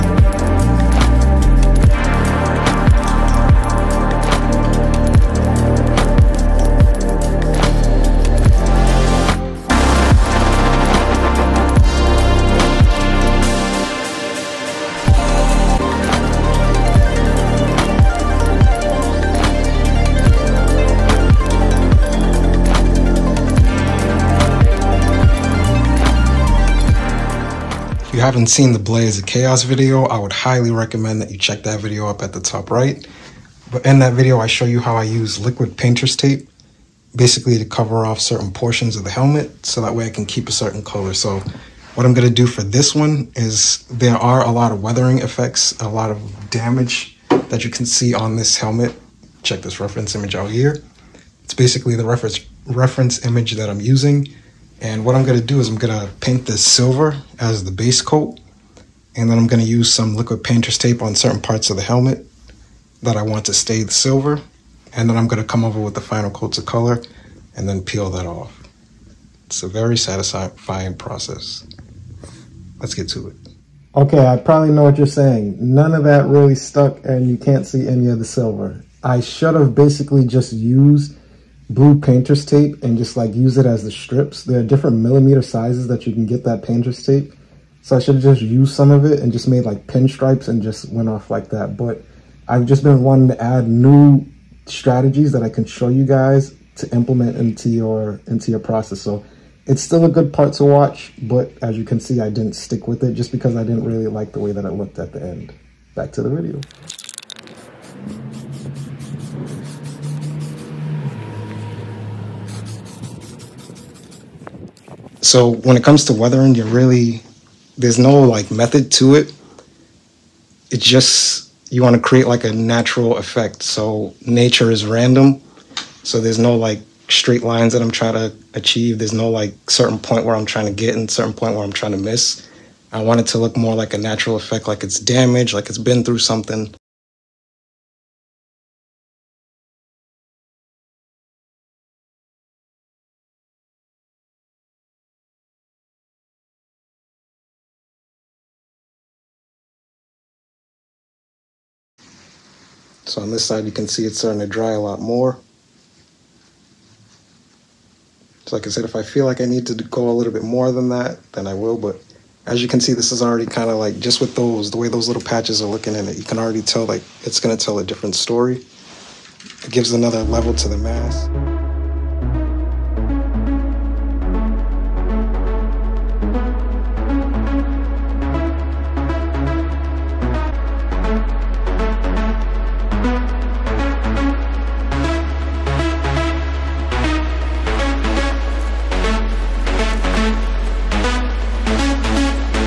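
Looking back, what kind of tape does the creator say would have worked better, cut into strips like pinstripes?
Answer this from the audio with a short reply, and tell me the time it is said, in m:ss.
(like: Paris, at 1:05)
Blue painter's tape, at 1:21.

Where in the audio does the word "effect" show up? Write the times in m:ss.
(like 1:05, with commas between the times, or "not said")
0:45, 2:03, 2:14.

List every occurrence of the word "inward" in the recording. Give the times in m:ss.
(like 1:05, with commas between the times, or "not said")
not said.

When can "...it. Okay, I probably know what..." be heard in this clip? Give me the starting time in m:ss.
1:13.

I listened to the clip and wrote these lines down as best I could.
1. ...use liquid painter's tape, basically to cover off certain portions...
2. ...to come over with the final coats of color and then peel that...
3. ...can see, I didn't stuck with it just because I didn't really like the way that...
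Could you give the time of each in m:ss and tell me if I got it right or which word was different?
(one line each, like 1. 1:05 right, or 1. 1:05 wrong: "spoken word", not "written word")
1. 0:35 right
2. 1:05 right
3. 1:41 wrong: "stick", not "stuck".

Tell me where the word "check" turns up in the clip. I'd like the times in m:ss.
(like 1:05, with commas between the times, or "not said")
0:31, 0:49.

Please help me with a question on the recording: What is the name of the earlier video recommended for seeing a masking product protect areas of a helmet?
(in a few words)
Blaze of Chaos.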